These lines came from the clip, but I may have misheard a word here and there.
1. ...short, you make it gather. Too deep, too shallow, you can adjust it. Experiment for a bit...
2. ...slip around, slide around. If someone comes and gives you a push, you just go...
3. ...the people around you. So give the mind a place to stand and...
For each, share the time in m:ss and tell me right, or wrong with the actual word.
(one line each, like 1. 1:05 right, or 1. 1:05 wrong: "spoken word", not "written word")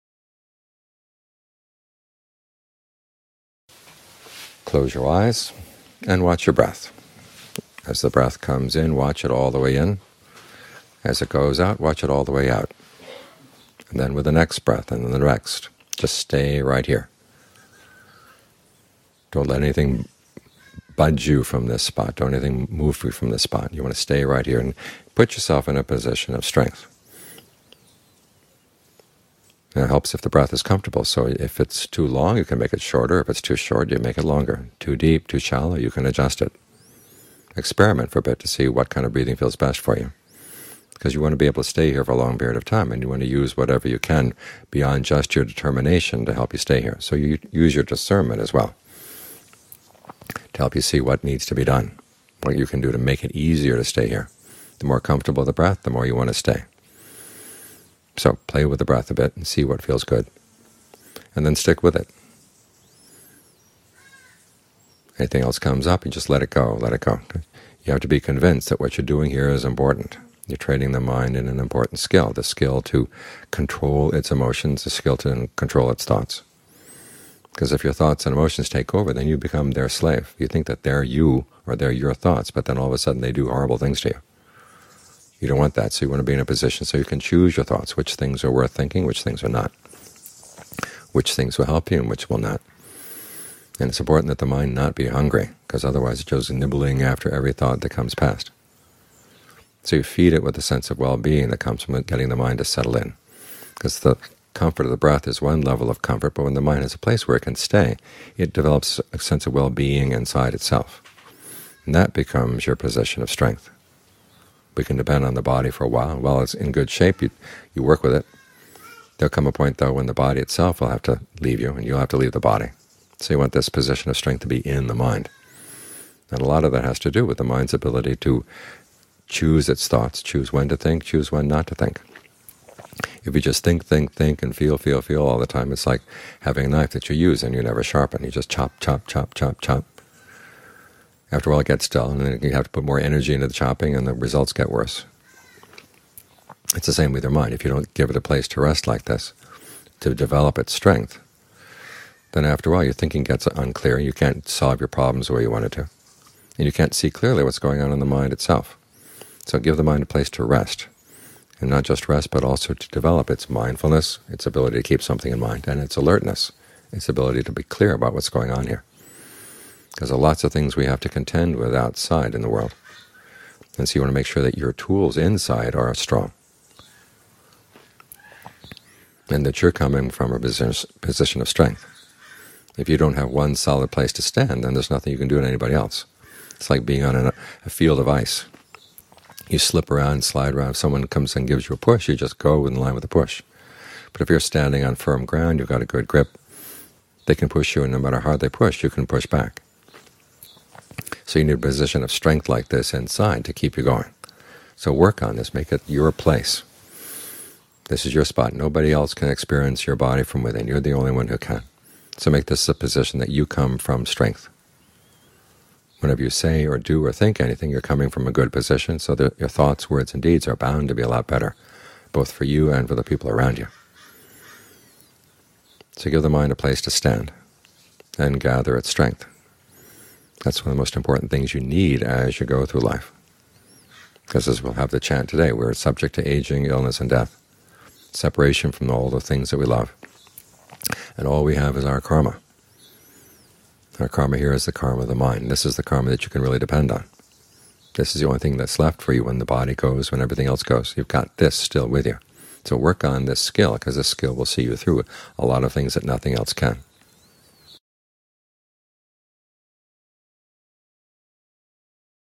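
1. 0:33 wrong: "longer", not "gather"
2. 3:09 right
3. 3:42 right.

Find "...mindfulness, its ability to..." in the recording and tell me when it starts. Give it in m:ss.
2:43.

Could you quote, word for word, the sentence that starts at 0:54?
The more comfortable the breath, the more you want to stay.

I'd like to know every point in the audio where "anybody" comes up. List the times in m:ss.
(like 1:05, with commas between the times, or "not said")
3:05.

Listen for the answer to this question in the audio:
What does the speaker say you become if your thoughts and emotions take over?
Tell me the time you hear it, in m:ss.
1:19.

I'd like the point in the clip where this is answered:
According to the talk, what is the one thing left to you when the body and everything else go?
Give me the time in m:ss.
4:04.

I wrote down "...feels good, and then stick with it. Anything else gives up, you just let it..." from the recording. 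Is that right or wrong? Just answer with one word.
wrong.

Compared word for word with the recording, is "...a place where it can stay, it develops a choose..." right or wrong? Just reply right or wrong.
wrong.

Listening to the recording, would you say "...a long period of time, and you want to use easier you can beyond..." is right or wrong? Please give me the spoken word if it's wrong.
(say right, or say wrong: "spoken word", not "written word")
wrong: "whatever", not "easier".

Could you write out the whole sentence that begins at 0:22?
Don't anything move you from this spot.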